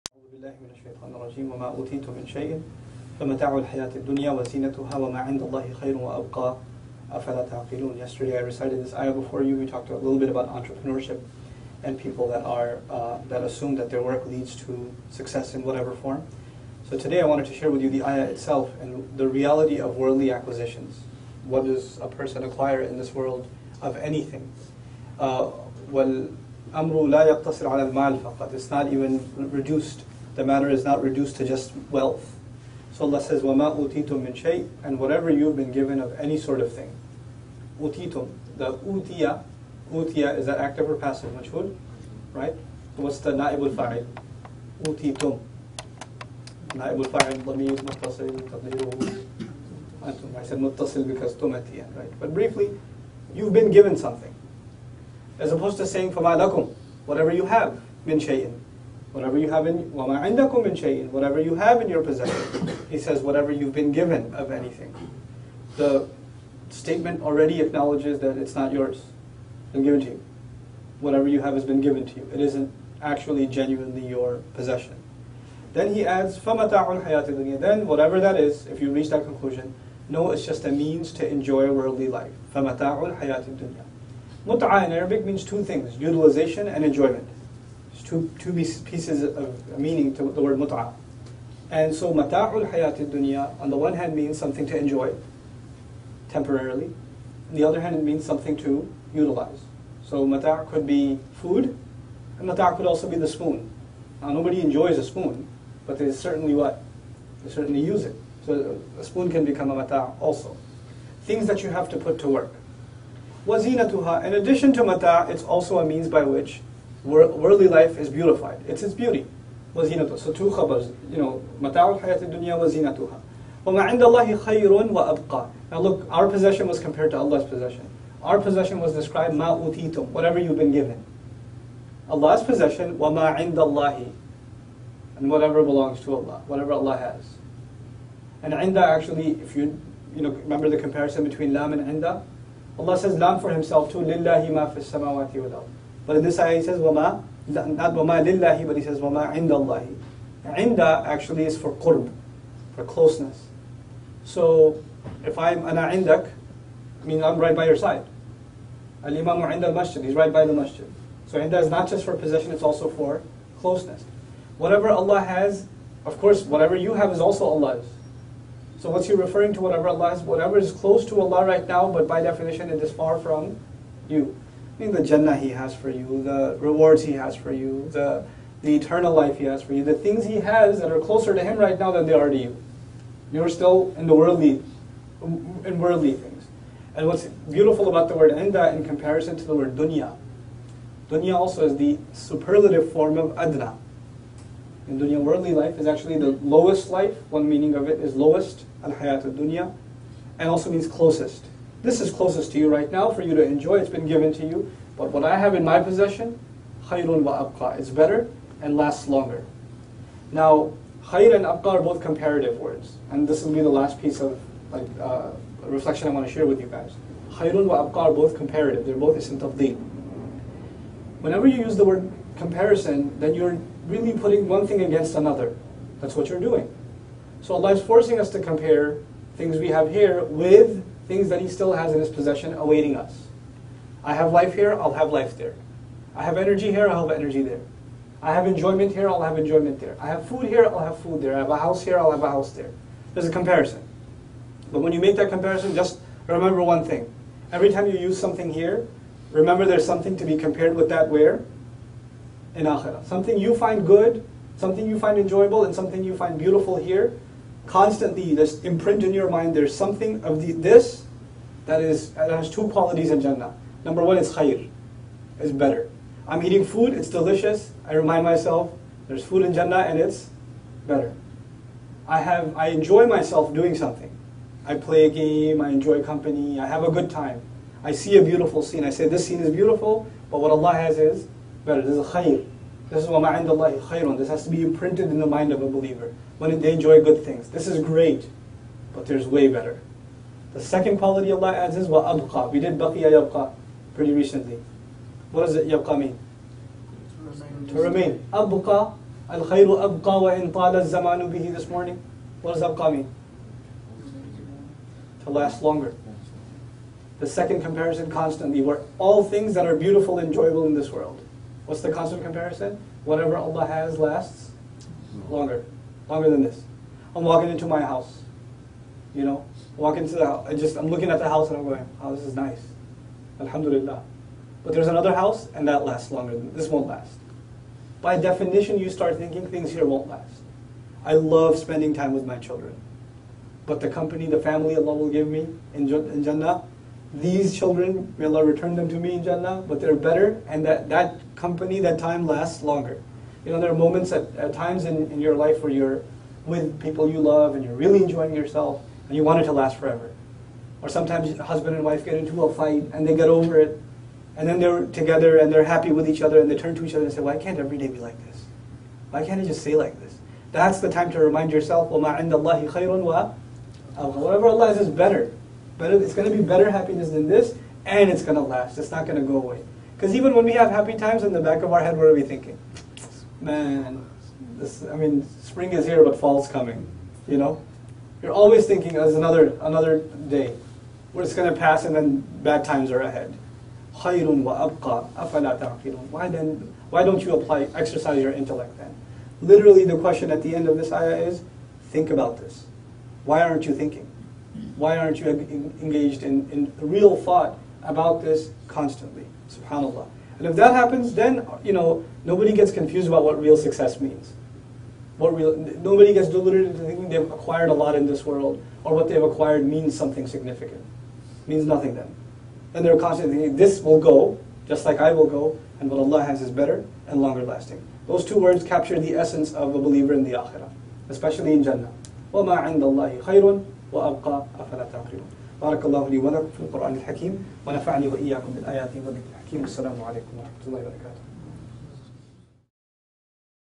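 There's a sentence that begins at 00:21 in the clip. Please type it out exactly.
What does a person acquire in this world of anything?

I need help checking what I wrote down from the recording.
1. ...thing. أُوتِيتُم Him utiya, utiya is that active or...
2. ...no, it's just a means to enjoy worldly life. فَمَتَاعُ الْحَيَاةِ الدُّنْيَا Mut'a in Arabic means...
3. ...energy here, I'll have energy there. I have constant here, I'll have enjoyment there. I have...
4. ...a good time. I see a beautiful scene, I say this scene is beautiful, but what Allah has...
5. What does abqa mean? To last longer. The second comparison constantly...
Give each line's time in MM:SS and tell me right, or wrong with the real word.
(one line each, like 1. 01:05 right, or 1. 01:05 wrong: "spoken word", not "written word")
1. 00:36 wrong: "The", not "Him"
2. 01:20 right
3. 03:56 wrong: "enjoyment", not "constant"
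4. 04:36 right
5. 05:02 right.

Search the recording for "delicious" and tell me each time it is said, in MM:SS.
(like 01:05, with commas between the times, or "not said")
04:27.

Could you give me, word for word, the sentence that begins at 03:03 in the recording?
You're still in the worldly, in worldly things.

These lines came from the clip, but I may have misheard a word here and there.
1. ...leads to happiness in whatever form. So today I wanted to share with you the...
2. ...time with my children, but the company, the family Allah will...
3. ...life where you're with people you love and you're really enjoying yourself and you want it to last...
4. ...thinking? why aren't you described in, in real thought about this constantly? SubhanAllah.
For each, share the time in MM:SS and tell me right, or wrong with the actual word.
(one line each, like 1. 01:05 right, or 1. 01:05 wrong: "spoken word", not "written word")
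1. 00:14 wrong: "success", not "happiness"
2. 05:31 right
3. 05:45 right
4. 06:33 wrong: "engaged", not "described".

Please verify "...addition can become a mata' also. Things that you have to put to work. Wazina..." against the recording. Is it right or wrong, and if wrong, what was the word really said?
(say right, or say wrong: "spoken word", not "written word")
wrong: "spoon", not "addition".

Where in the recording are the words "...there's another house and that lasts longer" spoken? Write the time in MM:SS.
05:24.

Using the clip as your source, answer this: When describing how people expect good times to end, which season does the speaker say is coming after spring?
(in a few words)
fall.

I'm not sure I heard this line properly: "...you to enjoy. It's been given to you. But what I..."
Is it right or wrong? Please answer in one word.
right.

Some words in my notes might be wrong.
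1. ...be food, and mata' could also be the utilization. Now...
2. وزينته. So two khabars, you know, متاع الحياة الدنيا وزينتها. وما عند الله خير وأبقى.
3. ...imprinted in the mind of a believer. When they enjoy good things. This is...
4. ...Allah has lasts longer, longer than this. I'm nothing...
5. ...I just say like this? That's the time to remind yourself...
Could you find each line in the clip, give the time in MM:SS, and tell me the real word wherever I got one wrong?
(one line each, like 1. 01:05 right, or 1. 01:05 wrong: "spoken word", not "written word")
1. 01:40 wrong: "spoon", not "utilization"
2. 01:59 right
3. 04:44 right
4. 05:13 wrong: "walking", not "nothing"
5. 05:59 right.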